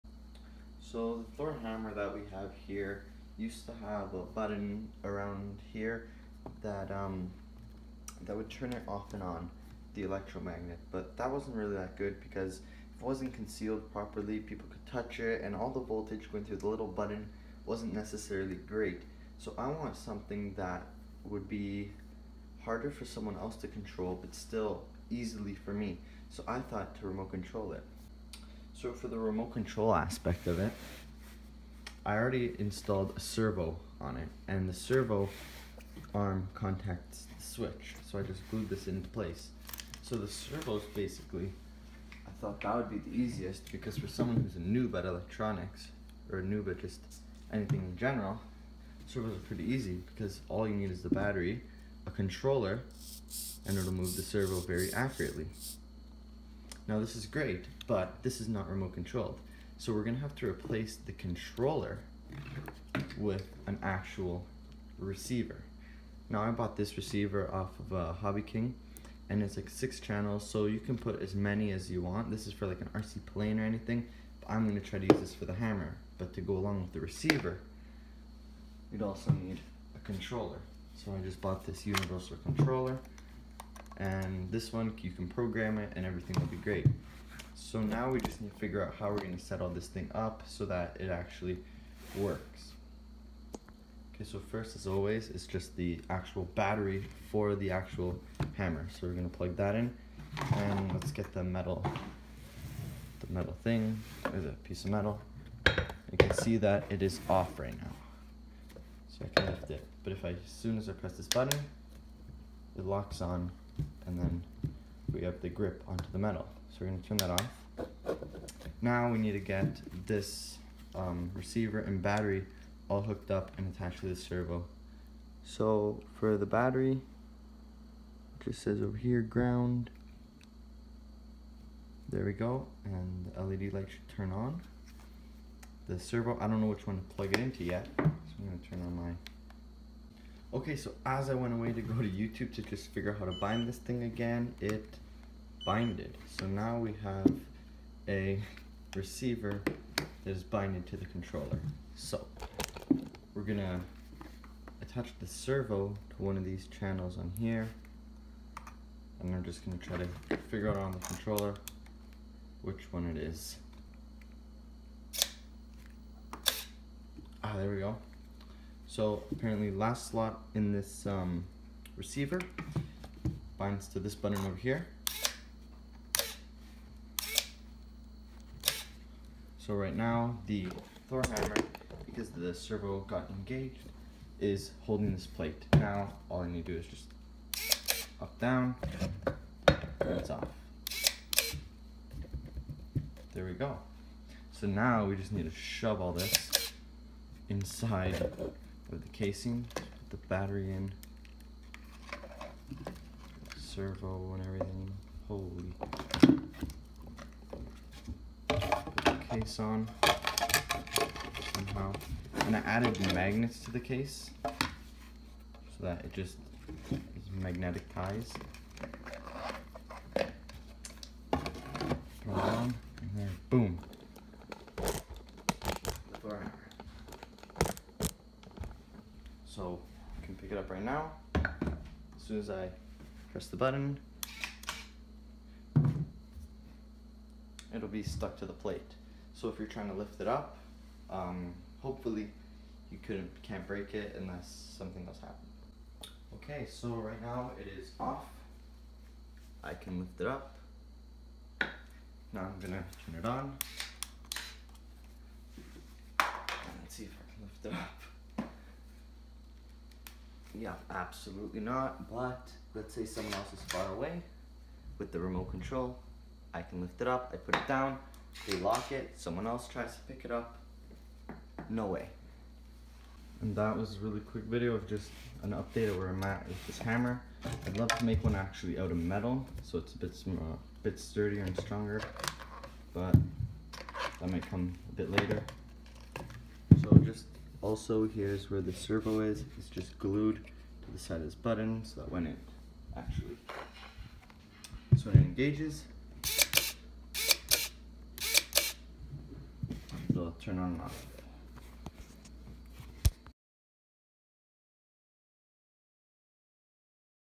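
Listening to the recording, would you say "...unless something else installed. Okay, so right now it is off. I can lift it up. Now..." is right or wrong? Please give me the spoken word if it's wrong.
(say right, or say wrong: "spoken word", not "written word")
wrong: "happened", not "installed".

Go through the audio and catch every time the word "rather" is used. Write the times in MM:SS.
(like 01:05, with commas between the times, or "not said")
not said.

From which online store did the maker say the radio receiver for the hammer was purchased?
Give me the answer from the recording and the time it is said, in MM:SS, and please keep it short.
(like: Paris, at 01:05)
Hobby King, at 01:08.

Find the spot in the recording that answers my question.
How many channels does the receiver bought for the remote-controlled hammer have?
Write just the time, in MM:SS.
01:09.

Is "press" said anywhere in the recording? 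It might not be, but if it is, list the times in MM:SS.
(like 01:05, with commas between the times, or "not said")
01:50, 03:53.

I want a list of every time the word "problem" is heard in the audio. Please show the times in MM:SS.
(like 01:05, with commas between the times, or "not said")
not said.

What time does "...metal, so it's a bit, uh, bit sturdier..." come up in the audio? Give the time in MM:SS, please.
04:38.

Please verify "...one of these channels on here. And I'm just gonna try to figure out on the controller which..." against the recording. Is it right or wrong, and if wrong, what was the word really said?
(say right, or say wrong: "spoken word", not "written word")
right.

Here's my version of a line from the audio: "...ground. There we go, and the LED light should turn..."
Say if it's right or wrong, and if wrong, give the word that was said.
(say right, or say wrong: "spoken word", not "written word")
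right.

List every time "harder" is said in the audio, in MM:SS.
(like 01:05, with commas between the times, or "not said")
00:22.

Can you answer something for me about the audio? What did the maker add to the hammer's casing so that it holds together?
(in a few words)
magnets.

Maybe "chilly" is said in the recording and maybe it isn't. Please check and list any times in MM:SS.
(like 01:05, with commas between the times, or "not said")
not said.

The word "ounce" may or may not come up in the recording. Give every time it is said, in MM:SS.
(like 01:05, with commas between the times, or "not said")
not said.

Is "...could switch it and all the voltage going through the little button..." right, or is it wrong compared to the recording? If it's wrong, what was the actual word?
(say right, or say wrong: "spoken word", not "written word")
wrong: "touch", not "switch".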